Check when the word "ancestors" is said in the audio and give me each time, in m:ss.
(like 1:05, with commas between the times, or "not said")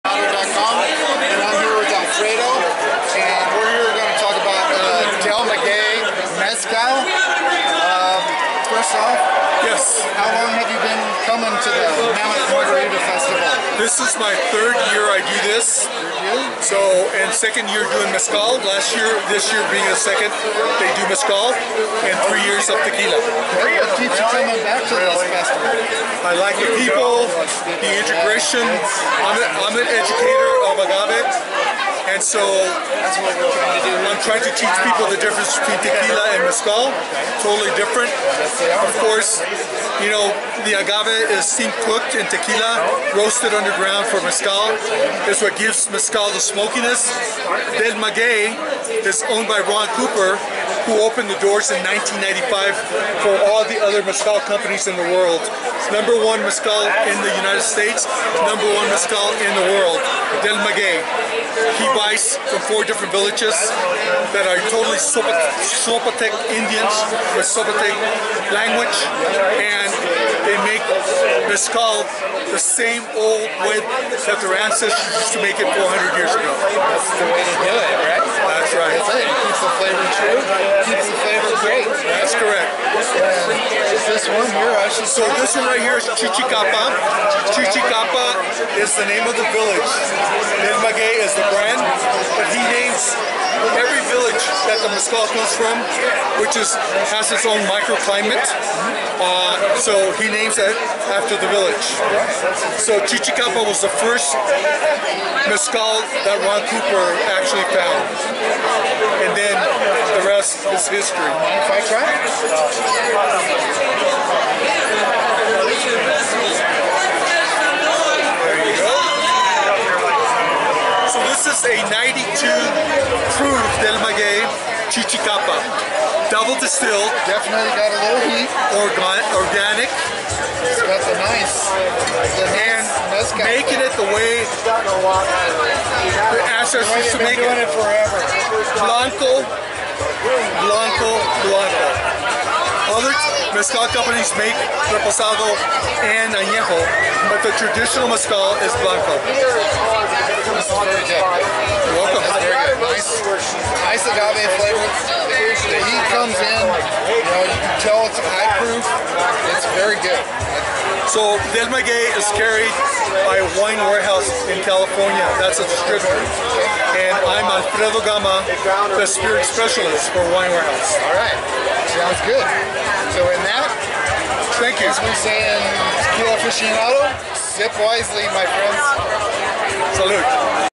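1:14, 2:16.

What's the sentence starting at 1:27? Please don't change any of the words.
Chichicapa is the name of the village.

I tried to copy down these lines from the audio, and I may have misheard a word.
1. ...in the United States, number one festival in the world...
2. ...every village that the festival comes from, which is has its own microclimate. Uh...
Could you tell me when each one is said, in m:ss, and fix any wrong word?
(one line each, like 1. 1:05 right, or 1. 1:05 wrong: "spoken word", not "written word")
1. 0:57 wrong: "mezcal", not "festival"
2. 1:33 wrong: "mezcal", not "festival".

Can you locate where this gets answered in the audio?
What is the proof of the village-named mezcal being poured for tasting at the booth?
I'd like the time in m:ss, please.
2:01.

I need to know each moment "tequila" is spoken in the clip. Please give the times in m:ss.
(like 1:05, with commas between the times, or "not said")
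0:22, 0:35, 0:42, 2:56.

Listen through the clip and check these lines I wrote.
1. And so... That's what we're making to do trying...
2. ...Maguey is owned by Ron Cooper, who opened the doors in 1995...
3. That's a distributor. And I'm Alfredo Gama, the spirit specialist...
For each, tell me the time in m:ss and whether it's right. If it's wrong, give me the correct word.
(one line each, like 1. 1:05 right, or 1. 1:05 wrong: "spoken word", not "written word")
1. 0:32 wrong: "trying", not "making"
2. 0:47 right
3. 2:45 right.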